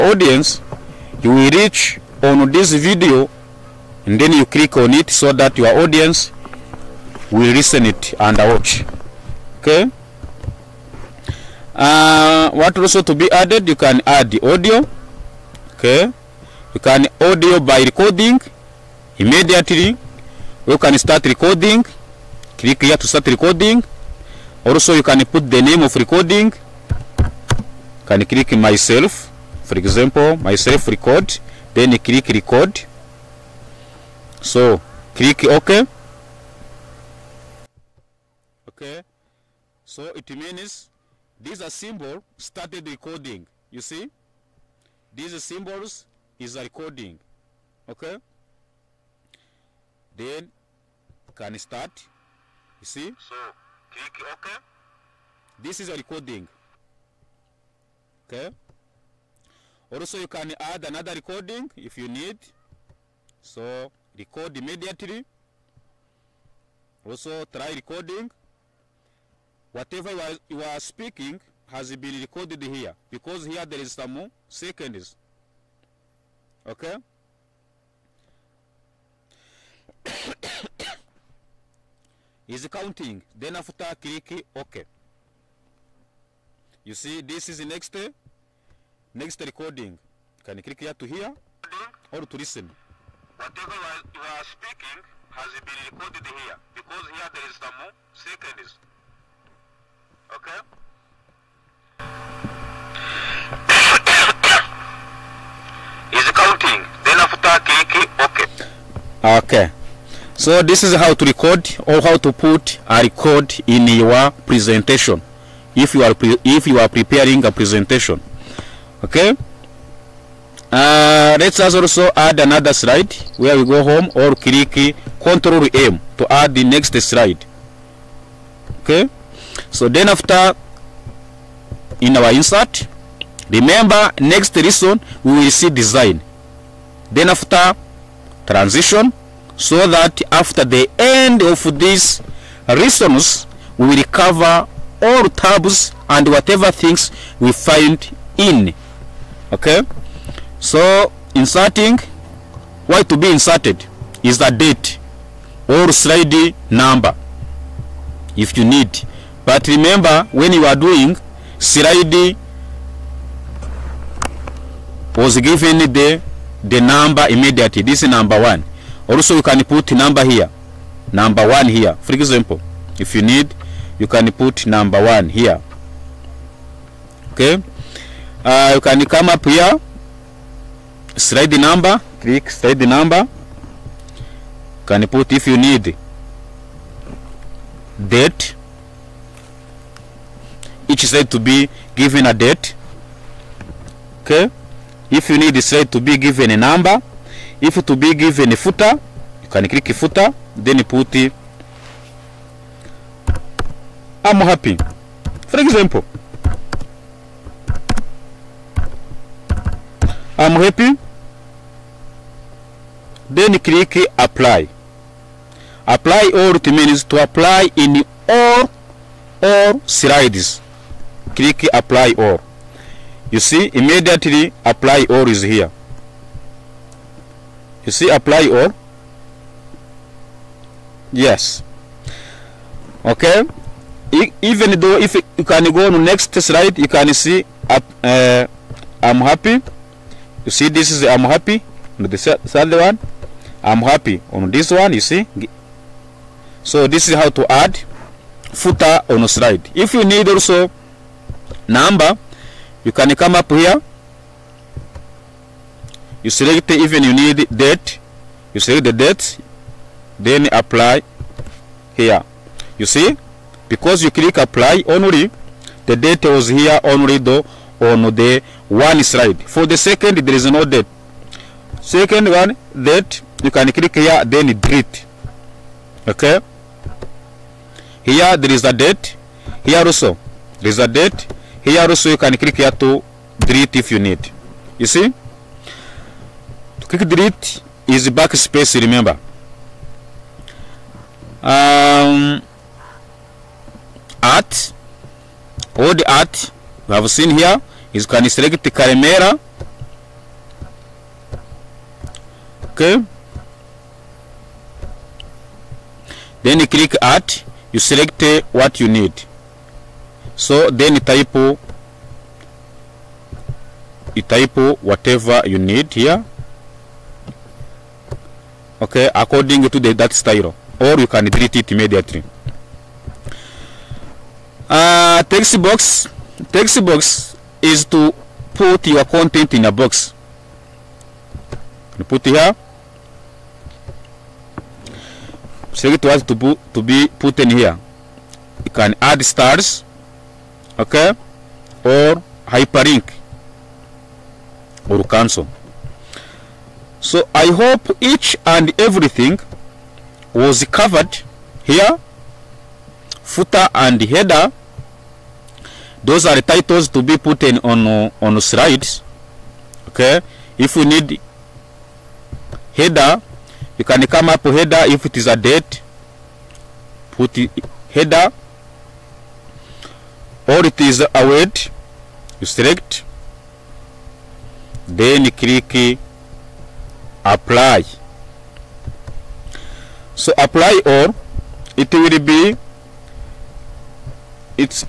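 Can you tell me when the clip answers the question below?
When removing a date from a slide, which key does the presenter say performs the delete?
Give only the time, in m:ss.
4:48.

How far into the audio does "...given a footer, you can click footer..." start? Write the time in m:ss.
3:18.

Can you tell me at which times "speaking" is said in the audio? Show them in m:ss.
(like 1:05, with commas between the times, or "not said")
1:10, 1:34.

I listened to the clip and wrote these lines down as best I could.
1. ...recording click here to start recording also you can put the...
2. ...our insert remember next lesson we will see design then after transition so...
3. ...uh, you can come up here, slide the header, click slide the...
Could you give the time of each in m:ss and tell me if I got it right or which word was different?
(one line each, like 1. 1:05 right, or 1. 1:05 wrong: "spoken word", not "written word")
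1. 0:21 right
2. 2:12 right
3. 2:58 wrong: "number", not "header".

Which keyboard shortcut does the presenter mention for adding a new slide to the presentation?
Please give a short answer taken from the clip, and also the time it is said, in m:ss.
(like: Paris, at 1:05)
Control M, at 2:05.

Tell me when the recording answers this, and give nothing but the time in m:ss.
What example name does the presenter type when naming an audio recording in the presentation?
0:30.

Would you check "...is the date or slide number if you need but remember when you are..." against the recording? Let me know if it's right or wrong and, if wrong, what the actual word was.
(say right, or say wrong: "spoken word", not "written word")
right.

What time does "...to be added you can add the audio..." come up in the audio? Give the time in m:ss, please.
0:13.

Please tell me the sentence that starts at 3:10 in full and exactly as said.
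Each slide to be given a date.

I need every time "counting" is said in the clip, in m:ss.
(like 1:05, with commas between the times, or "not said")
1:22.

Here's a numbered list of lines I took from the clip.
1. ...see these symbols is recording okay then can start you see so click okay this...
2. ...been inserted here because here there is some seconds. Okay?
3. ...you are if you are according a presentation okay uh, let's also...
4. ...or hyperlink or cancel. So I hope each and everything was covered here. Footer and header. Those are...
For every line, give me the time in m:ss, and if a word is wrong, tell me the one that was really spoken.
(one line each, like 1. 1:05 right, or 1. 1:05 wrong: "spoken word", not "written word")
1. 0:43 right
2. 1:11 wrong: "recorded", not "inserted"
3. 1:55 wrong: "preparing", not "according"
4. 5:41 right.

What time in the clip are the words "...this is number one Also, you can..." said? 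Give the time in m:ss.
2:47.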